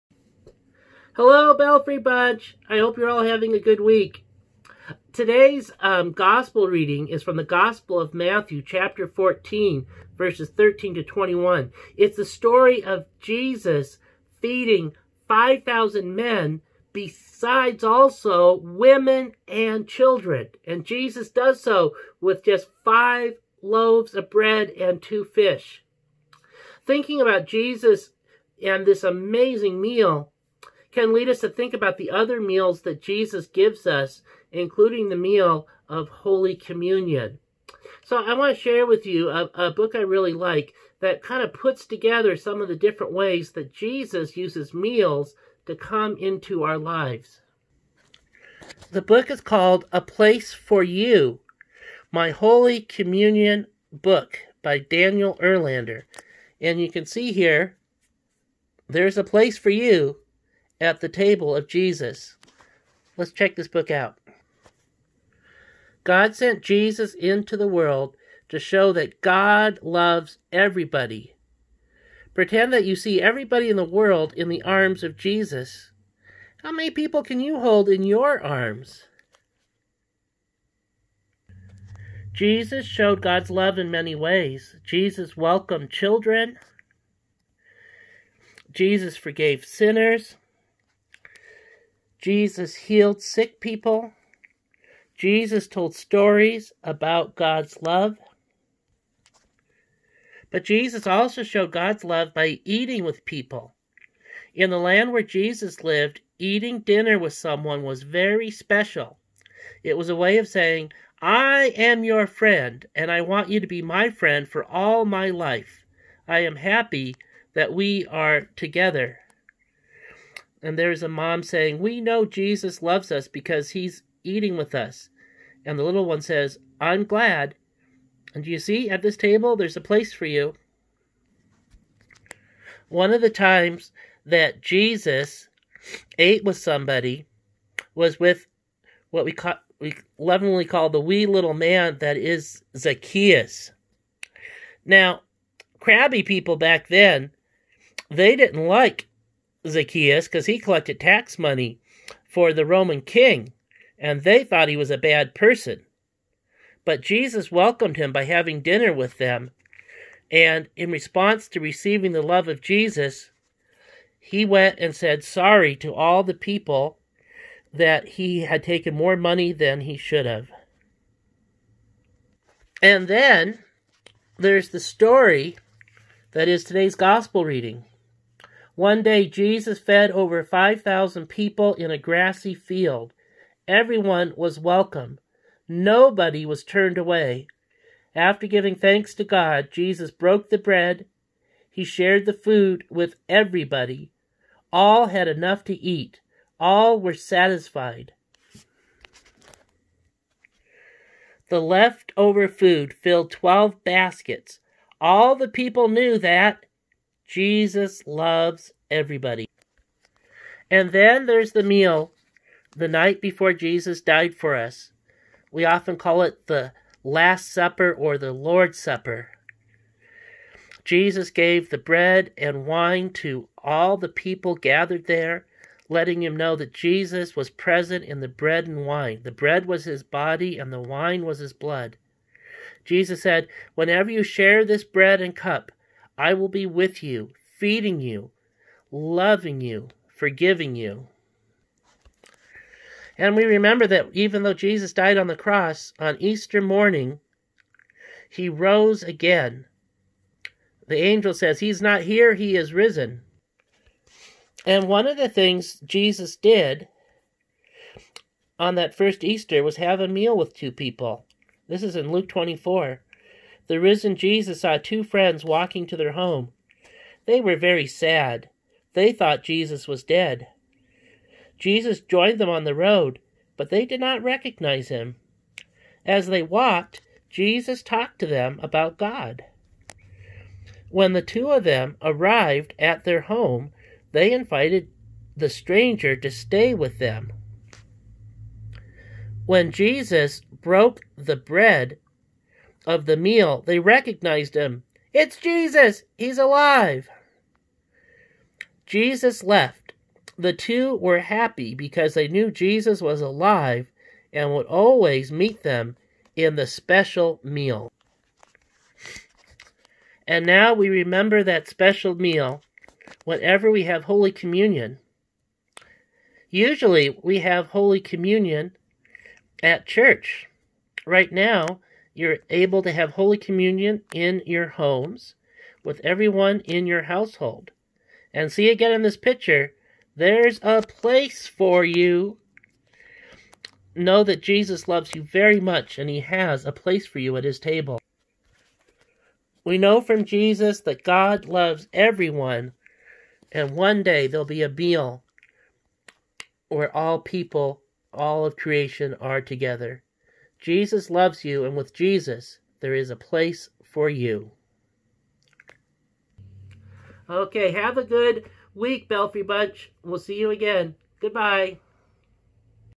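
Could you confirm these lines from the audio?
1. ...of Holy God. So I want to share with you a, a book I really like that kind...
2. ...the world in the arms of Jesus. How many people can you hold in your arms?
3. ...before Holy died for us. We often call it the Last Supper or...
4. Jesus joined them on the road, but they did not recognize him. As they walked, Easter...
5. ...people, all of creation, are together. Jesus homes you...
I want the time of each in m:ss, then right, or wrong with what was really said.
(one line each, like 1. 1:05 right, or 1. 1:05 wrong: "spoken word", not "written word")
1. 0:35 wrong: "Communion", not "God"
2. 1:13 right
3. 3:33 wrong: "Jesus", not "Holy"
4. 4:31 wrong: "Jesus", not "Easter"
5. 5:47 wrong: "loves", not "homes".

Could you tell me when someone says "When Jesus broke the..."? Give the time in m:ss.
4:49.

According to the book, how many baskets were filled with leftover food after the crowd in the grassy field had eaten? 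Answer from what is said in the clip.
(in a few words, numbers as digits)
12.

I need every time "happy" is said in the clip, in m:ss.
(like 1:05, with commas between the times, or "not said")
1:56, 5:01.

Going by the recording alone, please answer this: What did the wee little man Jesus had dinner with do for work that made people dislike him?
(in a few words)
Collected tax money.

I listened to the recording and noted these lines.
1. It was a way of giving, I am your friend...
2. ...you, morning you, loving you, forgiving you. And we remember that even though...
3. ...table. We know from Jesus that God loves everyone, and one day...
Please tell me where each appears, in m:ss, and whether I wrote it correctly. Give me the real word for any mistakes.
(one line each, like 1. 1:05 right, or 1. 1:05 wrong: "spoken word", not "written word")
1. 1:49 wrong: "saying", not "giving"
2. 3:57 wrong: "feeding", not "morning"
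3. 5:37 right.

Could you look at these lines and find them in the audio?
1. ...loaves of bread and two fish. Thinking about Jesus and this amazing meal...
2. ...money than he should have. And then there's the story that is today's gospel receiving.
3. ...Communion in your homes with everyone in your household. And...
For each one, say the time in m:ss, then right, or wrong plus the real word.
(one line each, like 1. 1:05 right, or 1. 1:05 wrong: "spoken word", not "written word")
1. 0:23 right
2. 2:49 wrong: "reading", not "receiving"
3. 5:23 right.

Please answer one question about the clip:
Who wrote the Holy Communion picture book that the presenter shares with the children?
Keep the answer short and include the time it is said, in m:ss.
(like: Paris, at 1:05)
Daniel Erlander, at 0:54.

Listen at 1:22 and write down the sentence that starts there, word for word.
Jesus showed God's love in many ways.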